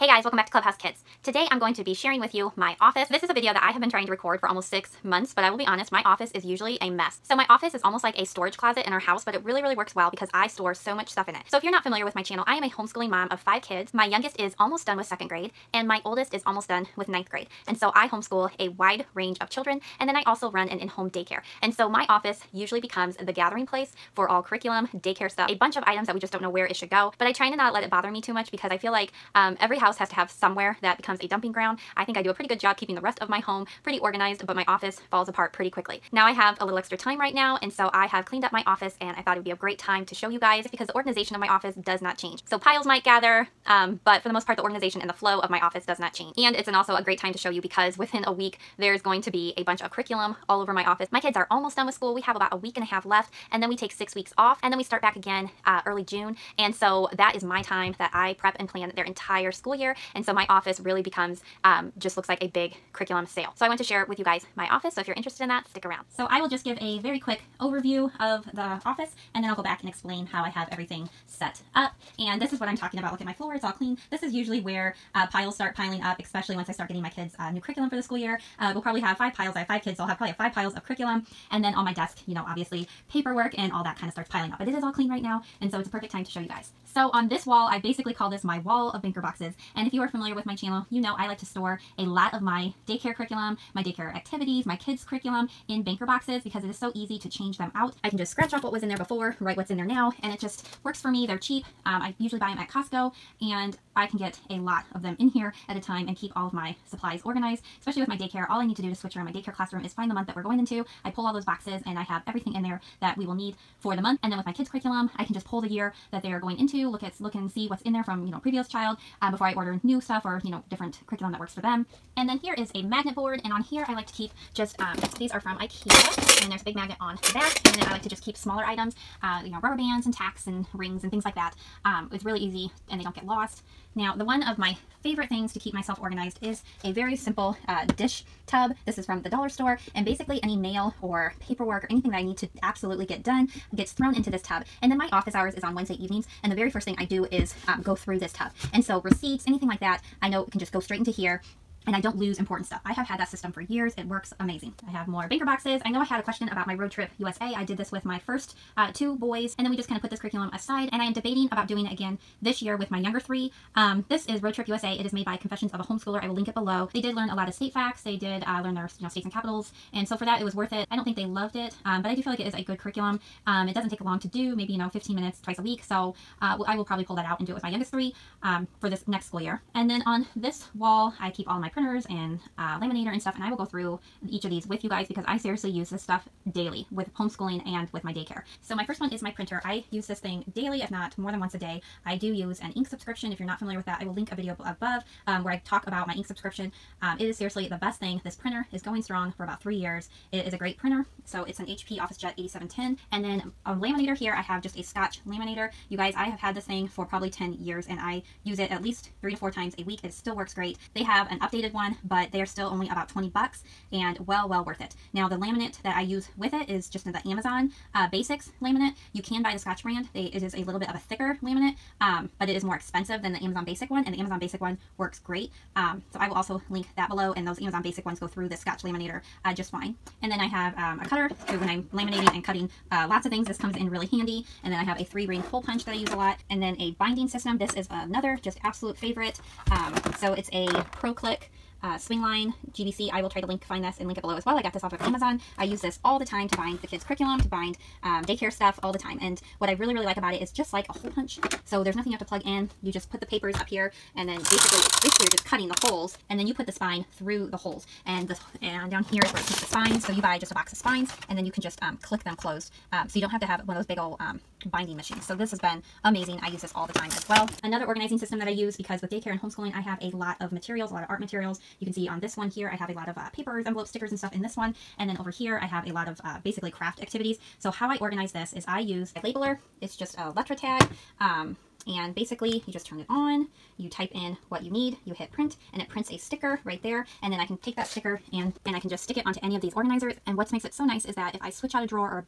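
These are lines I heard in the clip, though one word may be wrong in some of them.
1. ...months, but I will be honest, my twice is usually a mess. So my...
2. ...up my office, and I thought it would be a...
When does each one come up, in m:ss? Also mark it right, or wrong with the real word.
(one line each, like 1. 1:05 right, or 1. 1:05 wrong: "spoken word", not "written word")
1. 0:05 wrong: "office", not "twice"
2. 0:38 right.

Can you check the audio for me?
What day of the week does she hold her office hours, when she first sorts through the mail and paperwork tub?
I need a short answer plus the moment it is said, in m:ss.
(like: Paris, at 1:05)
Wednesday, at 2:25.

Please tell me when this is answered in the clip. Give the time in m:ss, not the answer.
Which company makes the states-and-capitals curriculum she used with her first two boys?
2:45.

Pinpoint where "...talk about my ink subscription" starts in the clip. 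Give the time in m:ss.
3:15.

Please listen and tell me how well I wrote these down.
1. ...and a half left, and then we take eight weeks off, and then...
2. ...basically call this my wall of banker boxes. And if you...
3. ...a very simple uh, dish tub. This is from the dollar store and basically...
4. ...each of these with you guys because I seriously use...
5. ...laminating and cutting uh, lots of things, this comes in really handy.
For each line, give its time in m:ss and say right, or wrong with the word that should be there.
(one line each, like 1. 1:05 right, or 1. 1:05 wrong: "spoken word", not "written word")
1. 0:52 wrong: "six", not "eight"
2. 1:27 right
3. 2:16 right
4. 3:04 right
5. 3:51 right.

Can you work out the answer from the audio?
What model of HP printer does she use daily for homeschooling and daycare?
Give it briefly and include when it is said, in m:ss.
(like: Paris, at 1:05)
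OfficeJet 8710, at 3:21.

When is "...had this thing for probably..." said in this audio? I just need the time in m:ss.
3:26.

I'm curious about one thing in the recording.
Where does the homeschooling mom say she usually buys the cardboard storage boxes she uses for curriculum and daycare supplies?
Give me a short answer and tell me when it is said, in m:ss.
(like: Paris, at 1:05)
Costco, at 1:42.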